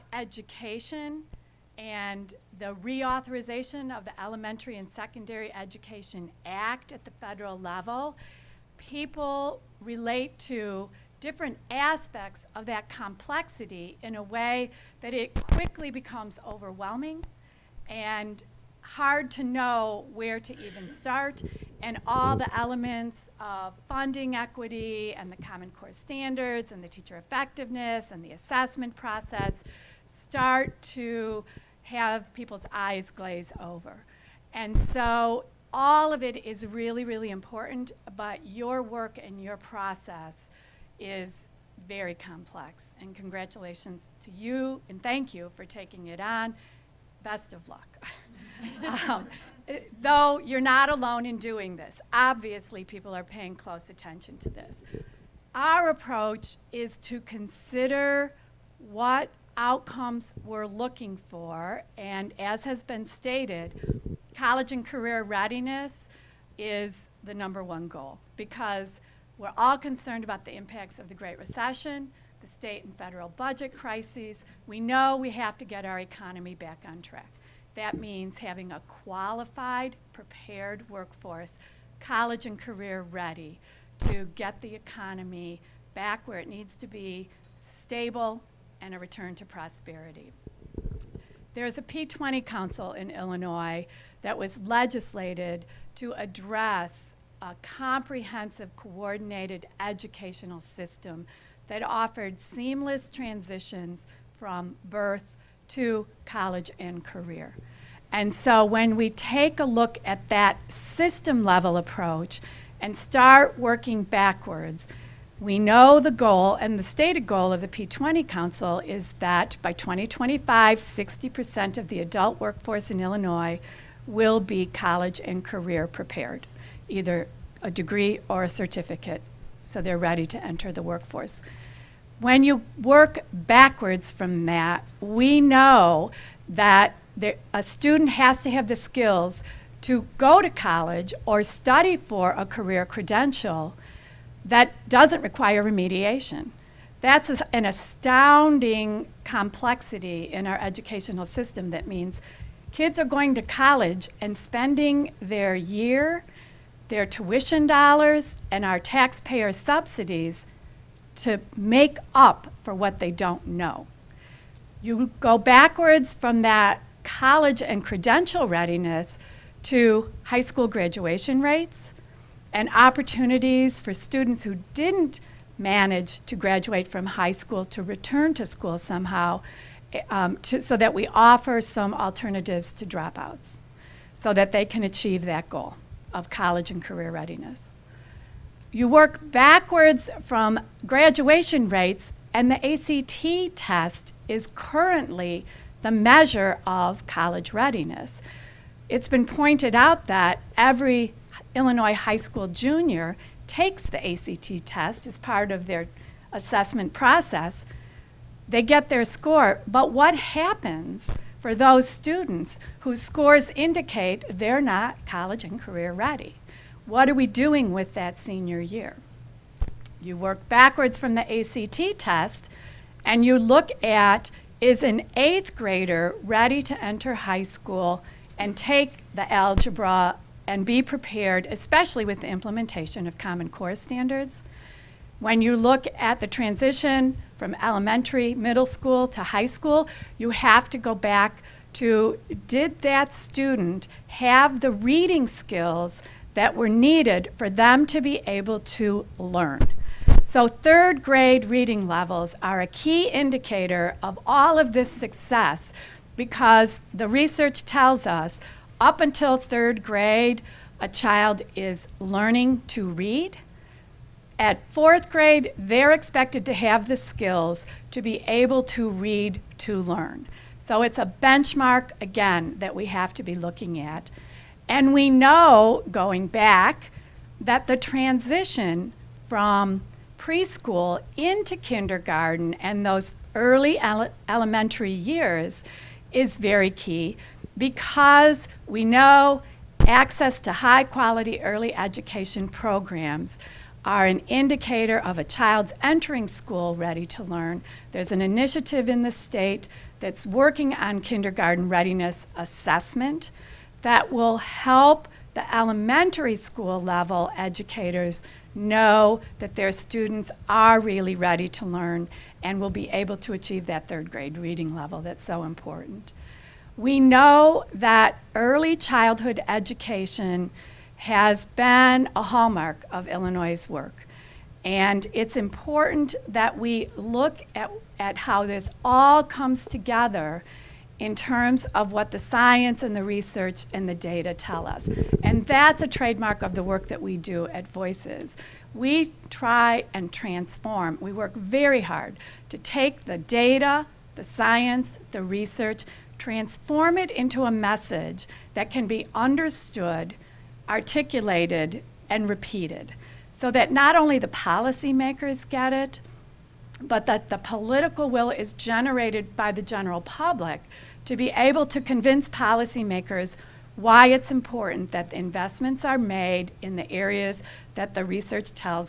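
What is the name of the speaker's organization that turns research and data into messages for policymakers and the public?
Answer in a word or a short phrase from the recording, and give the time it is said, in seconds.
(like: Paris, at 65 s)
Voices, at 337 s.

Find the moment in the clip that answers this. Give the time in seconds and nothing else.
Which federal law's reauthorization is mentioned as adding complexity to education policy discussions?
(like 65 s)
4 s.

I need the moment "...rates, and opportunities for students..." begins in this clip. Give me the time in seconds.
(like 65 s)
171 s.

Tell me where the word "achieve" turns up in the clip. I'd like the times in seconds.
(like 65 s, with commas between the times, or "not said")
184 s, 313 s.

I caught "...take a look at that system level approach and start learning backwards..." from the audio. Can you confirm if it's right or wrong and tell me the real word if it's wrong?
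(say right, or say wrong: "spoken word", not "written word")
wrong: "working", not "learning".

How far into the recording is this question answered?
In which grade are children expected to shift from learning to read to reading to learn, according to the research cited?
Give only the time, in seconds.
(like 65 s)
264 s.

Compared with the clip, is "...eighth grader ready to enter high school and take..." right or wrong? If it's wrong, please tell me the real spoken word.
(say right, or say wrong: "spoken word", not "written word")
right.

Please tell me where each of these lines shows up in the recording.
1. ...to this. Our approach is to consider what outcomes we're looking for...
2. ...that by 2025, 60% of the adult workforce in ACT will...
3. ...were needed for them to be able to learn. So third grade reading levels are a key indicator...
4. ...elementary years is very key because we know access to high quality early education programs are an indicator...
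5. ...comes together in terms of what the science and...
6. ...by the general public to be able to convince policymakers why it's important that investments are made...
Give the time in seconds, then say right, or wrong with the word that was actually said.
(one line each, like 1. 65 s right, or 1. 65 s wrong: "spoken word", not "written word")
1. 54 s right
2. 119 s wrong: "Illinois", not "ACT"
3. 246 s right
4. 284 s right
5. 329 s right
6. 359 s right.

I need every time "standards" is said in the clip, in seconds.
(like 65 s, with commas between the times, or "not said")
25 s, 233 s.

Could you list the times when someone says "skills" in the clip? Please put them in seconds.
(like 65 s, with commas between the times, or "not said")
138 s, 245 s, 266 s.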